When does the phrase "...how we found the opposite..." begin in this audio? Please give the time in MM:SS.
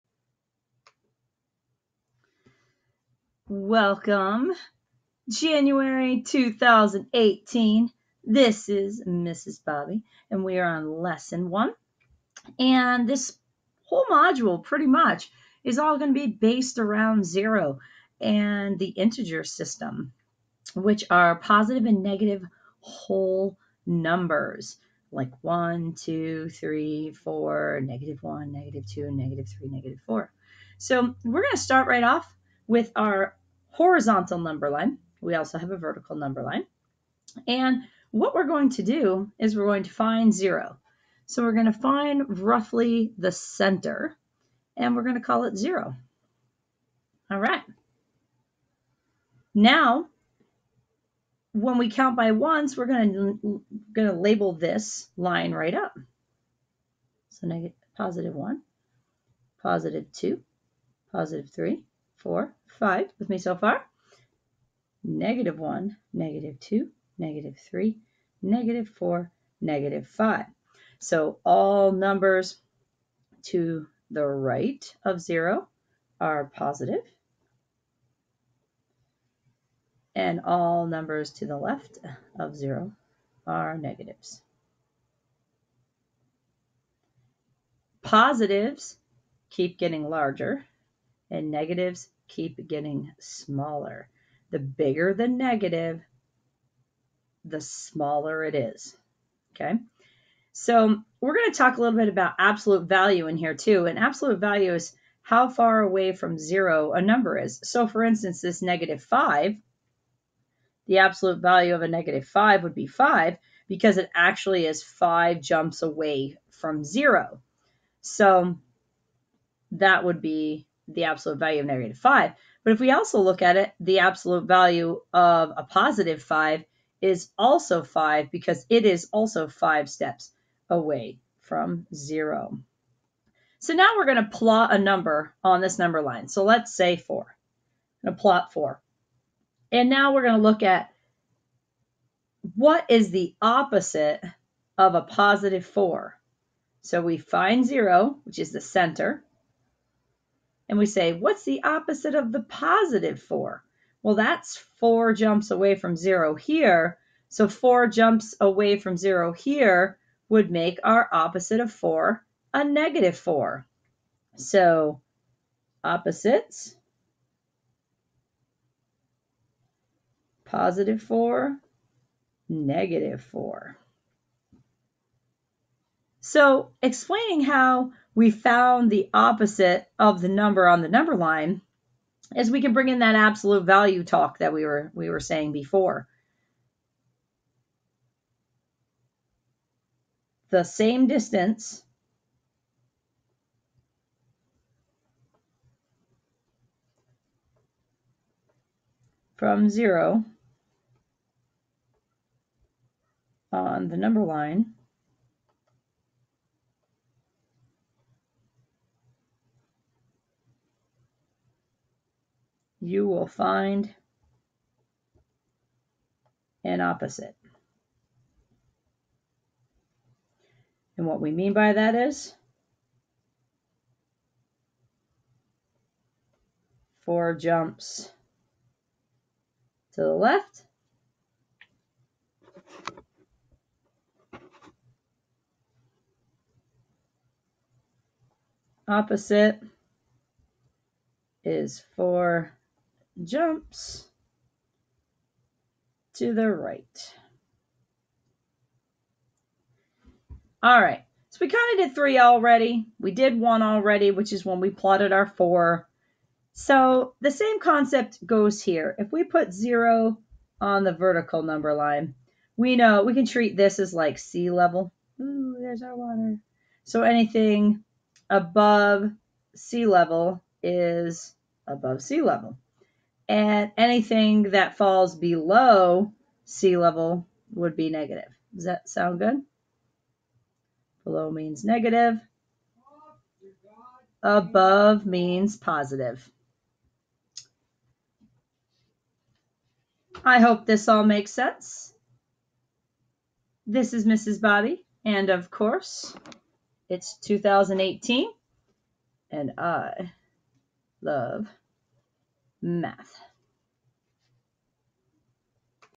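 02:57.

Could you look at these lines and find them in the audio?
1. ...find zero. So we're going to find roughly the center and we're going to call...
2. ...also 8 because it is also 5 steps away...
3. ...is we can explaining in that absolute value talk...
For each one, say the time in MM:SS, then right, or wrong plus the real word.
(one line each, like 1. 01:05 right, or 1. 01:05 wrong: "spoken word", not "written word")
1. 00:39 right
2. 02:07 wrong: "5", not "8"
3. 03:02 wrong: "bring", not "explaining".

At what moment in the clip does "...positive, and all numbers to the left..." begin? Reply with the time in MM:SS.
01:16.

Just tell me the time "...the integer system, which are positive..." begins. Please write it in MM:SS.
00:18.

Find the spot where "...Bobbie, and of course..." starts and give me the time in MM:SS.
04:54.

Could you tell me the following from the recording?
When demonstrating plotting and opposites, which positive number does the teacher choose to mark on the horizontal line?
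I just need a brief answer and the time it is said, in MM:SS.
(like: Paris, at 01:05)
4, at 02:16.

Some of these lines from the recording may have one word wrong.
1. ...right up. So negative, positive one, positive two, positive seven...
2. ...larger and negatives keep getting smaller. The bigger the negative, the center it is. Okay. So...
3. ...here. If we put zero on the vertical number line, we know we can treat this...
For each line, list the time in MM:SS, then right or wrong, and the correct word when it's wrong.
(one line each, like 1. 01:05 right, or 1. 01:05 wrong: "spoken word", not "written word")
1. 00:55 wrong: "three", not "seven"
2. 01:30 wrong: "smaller", not "center"
3. 04:18 right.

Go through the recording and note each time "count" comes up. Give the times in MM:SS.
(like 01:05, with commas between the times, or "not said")
00:51.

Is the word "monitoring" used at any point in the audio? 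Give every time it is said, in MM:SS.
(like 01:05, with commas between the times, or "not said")
not said.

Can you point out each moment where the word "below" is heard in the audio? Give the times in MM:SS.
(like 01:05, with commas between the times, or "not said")
04:35, 04:41.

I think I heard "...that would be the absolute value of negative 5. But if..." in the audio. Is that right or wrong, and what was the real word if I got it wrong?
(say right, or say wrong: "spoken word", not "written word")
right.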